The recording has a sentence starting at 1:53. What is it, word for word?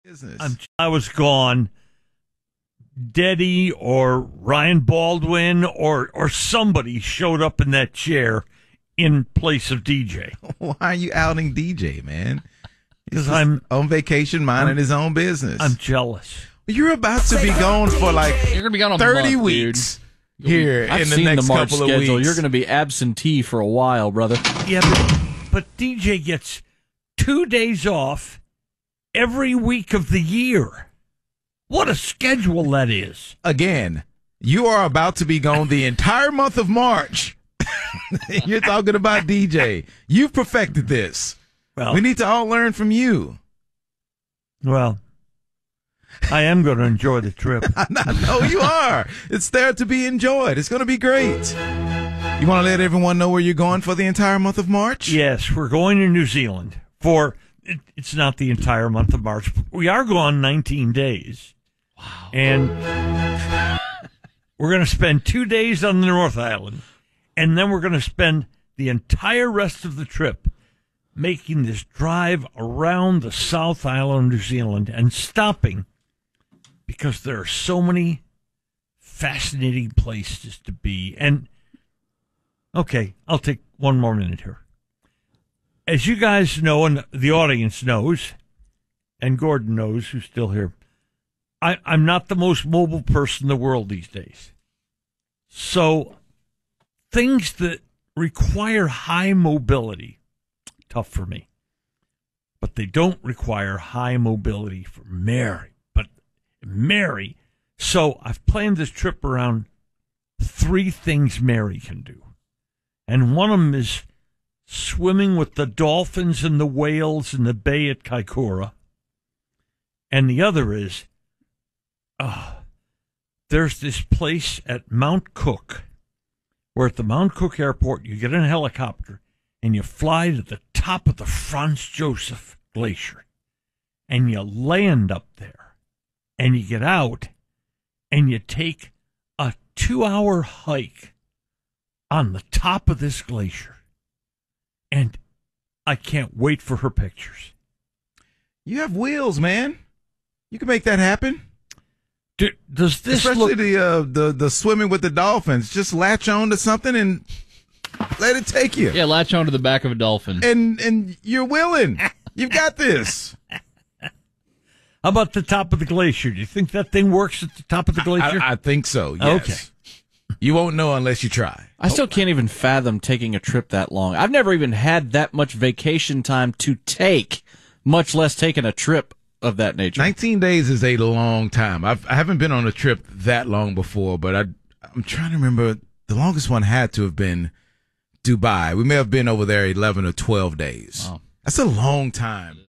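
And one of them is swimming with the dolphins and the whales in the bay at Kaikoura.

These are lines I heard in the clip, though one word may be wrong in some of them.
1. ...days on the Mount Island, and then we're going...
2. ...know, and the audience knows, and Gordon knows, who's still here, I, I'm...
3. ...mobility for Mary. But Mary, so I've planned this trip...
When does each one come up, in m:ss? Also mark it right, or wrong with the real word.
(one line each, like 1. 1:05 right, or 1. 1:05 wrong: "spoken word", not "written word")
1. 1:05 wrong: "North", not "Mount"
2. 1:26 right
3. 1:44 right.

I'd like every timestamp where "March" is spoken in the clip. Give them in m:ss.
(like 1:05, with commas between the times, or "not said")
0:36, 0:54, 0:59.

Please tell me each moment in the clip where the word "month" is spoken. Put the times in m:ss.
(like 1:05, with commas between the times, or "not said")
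0:19, 0:36, 0:54, 0:58.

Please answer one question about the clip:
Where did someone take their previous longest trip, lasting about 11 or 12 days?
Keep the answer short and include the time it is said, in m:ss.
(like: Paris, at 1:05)
Dubai, at 3:08.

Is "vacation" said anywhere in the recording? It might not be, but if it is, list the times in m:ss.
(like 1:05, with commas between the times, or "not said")
0:13, 2:55.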